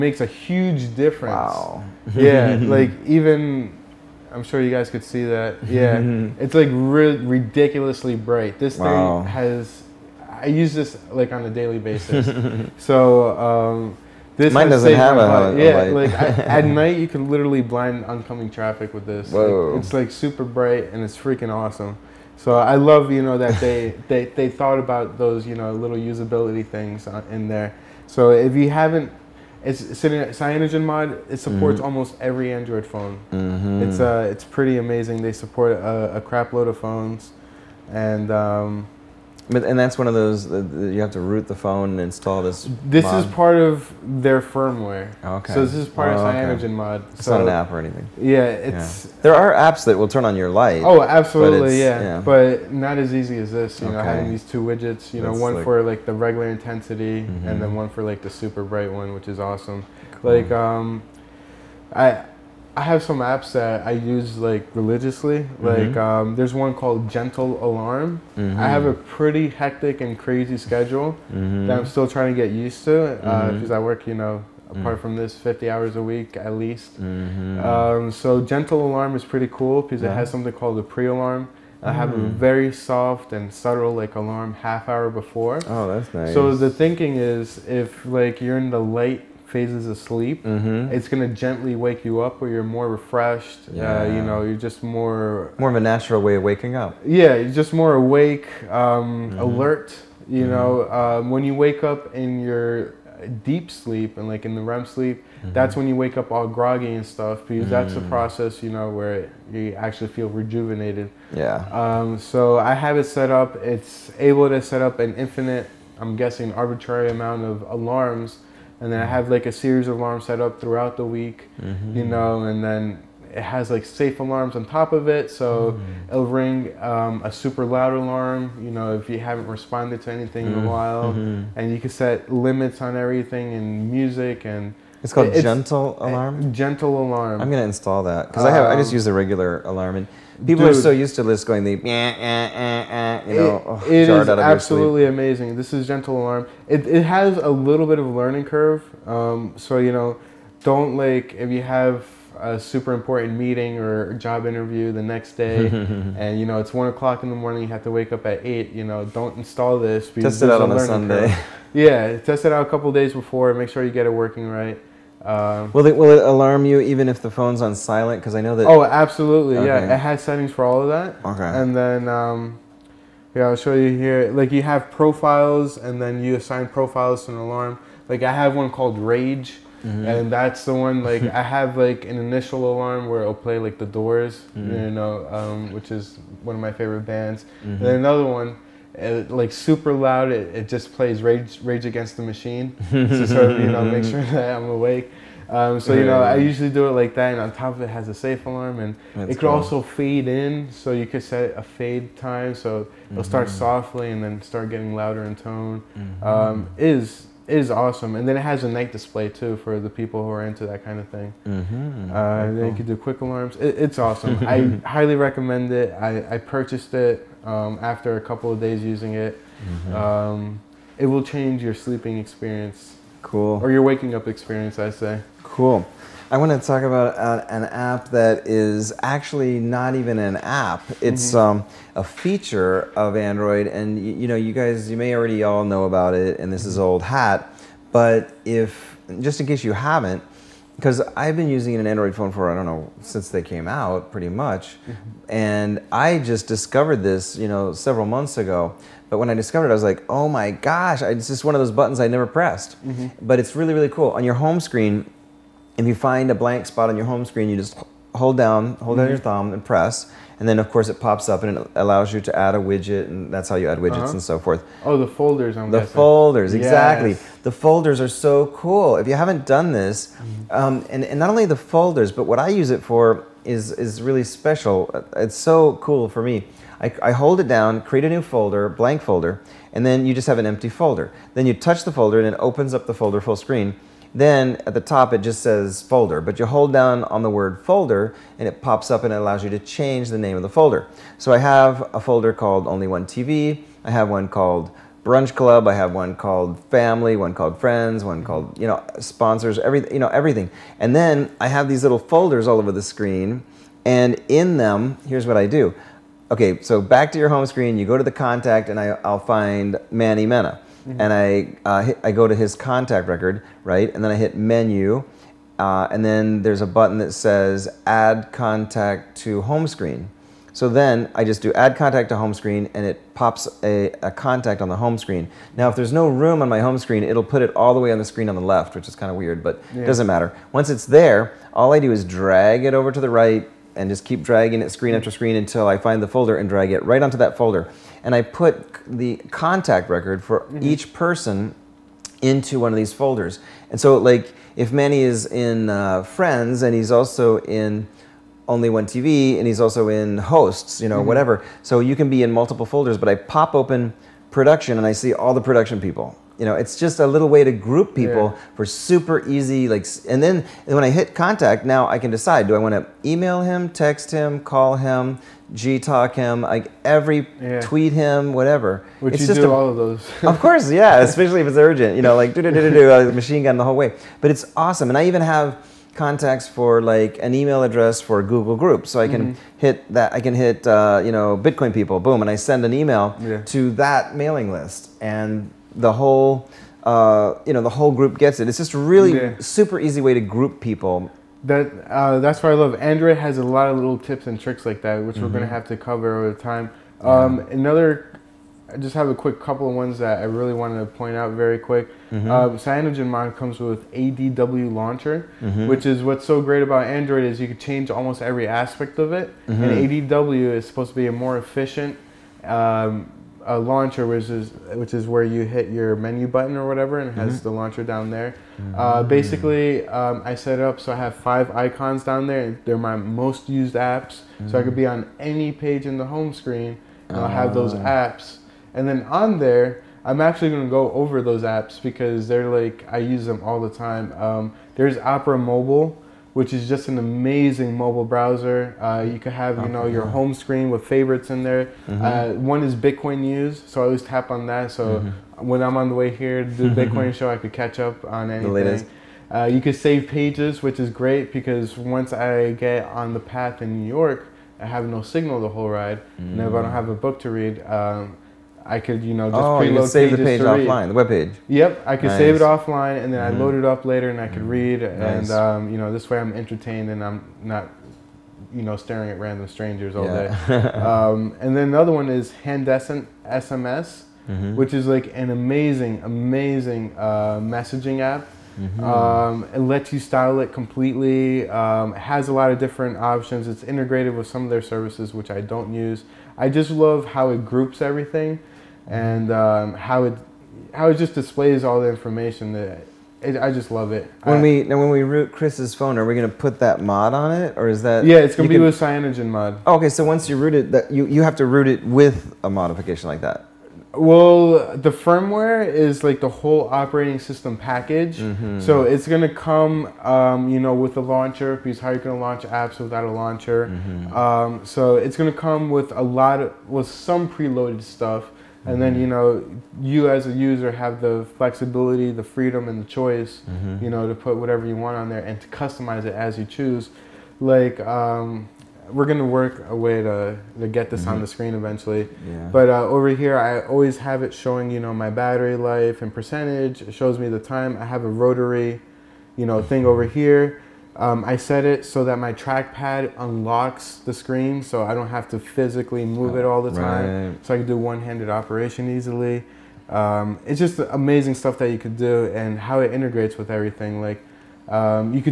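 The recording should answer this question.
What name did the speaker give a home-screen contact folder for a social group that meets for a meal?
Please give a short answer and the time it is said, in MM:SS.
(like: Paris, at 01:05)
Brunch Club, at 04:55.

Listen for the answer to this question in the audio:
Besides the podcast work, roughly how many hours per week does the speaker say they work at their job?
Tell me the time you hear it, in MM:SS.
01:15.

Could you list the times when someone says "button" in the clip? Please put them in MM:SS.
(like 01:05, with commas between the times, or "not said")
04:11, 05:16, 06:56.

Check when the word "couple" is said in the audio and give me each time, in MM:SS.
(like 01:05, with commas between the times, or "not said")
02:42, 03:38, 06:39.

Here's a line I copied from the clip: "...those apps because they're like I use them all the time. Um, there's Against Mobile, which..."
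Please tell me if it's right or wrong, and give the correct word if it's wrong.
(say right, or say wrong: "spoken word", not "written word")
wrong: "Opera", not "Against".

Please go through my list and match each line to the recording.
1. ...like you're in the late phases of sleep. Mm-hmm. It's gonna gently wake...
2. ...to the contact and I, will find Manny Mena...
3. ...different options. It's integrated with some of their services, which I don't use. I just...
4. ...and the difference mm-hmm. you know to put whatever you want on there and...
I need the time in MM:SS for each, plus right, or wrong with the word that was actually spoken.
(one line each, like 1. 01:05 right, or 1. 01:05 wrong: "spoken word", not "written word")
1. 01:28 right
2. 05:07 right
3. 08:02 right
4. 08:42 wrong: "choice", not "difference".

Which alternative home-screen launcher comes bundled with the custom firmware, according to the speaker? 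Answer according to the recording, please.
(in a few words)
ADW Launcher.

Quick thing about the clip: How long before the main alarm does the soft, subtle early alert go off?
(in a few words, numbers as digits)
half hour.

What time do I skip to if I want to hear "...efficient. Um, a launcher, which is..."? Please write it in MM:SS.
06:51.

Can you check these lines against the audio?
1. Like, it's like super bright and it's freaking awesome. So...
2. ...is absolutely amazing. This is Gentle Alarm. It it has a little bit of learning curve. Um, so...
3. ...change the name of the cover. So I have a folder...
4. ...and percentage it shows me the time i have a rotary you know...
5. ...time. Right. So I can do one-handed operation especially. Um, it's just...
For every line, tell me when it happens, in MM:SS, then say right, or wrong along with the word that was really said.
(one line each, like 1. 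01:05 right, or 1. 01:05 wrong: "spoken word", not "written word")
1. 00:19 right
2. 02:24 right
3. 04:49 wrong: "folder", not "cover"
4. 08:56 right
5. 09:06 wrong: "easily", not "especially".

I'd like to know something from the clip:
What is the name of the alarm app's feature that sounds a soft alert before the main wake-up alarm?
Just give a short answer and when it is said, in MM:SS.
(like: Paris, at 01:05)
pre alarm, at 01:20.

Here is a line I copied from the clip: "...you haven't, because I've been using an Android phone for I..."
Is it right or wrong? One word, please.
right.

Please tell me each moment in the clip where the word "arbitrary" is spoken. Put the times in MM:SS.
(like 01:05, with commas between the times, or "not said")
01:56.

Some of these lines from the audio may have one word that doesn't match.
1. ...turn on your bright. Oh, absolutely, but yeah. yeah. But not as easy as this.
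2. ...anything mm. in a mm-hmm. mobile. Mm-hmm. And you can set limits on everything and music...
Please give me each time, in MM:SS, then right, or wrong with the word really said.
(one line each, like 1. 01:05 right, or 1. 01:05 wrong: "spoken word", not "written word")
1. 00:50 wrong: "light", not "bright"
2. 02:10 wrong: "while", not "mobile".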